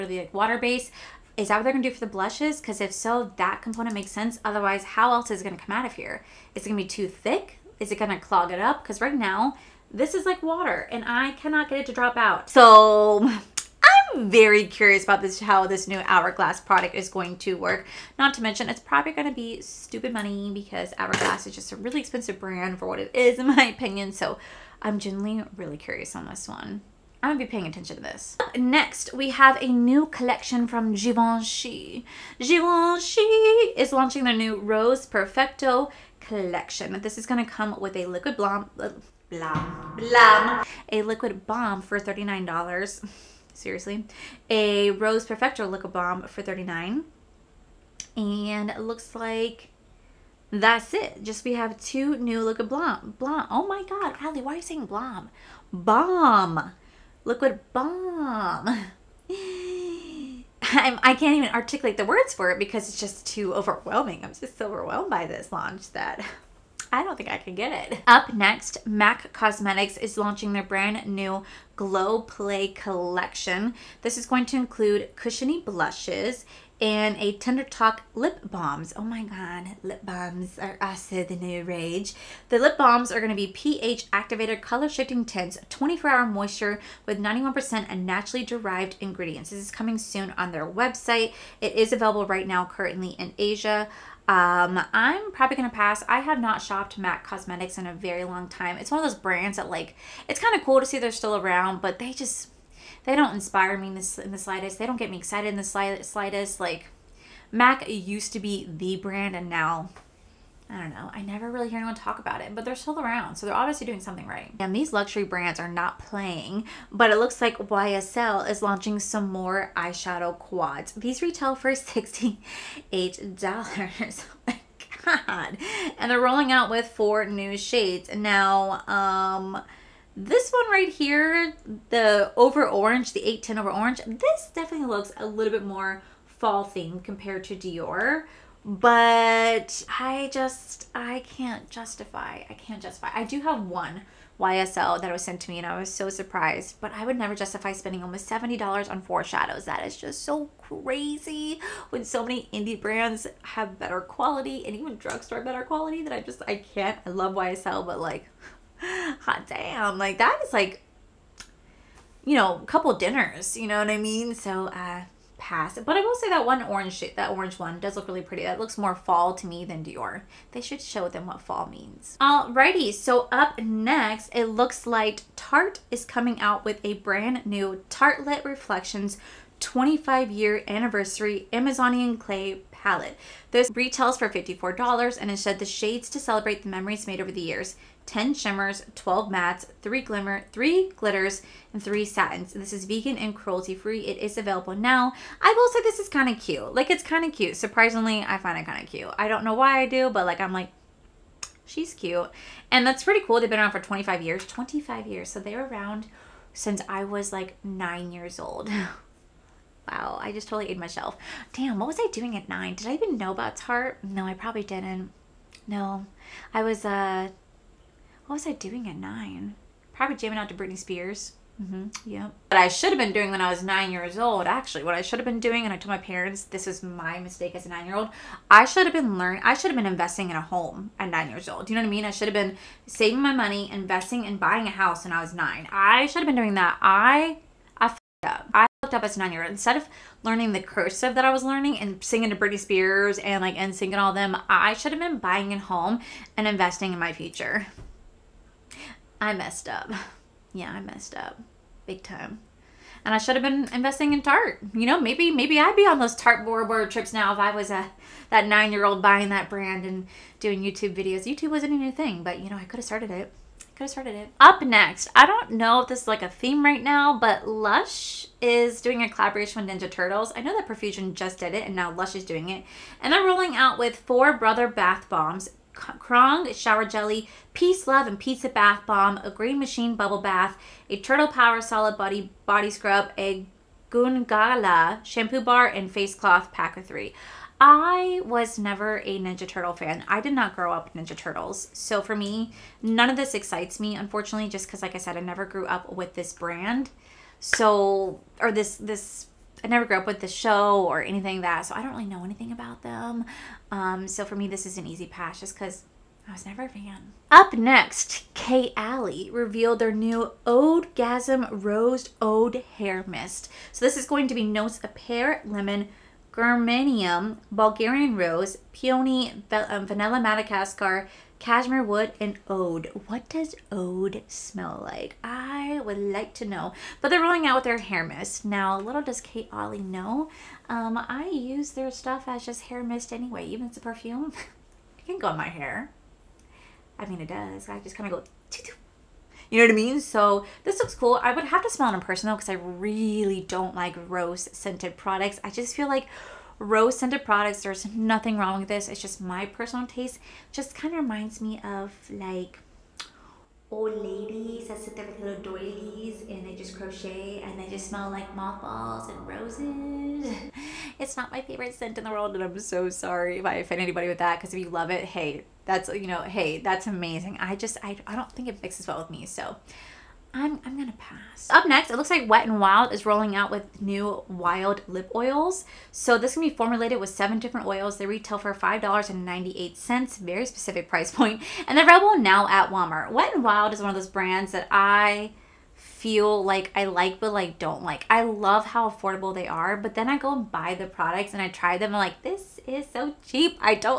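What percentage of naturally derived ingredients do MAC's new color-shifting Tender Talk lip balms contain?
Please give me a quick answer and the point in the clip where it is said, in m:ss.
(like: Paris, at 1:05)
91%, at 1:27.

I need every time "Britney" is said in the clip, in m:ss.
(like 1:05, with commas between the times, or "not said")
3:40, 4:02.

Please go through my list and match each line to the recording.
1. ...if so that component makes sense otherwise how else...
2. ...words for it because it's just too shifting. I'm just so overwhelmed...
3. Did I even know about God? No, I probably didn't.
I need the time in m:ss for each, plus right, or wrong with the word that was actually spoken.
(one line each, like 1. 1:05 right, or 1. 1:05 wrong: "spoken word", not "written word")
1. 0:02 right
2. 1:02 wrong: "overwhelming", not "shifting"
3. 3:32 wrong: "Tarte", not "God".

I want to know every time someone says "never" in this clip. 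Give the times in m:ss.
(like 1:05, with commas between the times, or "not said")
1:51, 2:27, 4:48, 4:55, 4:59, 5:06.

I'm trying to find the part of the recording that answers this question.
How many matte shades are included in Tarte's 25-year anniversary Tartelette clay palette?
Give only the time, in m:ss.
3:08.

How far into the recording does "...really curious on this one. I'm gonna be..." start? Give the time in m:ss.
0:25.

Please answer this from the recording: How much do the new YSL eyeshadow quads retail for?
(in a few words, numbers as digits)
$68.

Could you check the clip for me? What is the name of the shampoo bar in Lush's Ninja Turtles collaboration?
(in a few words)
Gungala.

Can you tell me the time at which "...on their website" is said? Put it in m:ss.
1:30.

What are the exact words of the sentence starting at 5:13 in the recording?
So this is going to be notes of pear, lemon, germanium, Bulgarian rose, peony, um, vanilla Madagascar, Cashmere wood and ode.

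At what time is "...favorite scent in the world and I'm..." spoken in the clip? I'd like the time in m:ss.
6:01.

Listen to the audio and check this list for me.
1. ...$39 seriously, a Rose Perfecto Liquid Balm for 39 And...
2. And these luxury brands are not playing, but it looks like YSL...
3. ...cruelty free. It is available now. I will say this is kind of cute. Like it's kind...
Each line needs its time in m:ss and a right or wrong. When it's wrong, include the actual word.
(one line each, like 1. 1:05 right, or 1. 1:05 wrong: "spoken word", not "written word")
1. 0:41 right
2. 1:54 right
3. 3:13 right.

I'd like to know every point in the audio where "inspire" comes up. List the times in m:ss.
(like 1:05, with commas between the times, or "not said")
1:43.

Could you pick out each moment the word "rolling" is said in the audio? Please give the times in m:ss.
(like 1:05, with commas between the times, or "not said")
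2:06, 4:33, 5:27, 6:13.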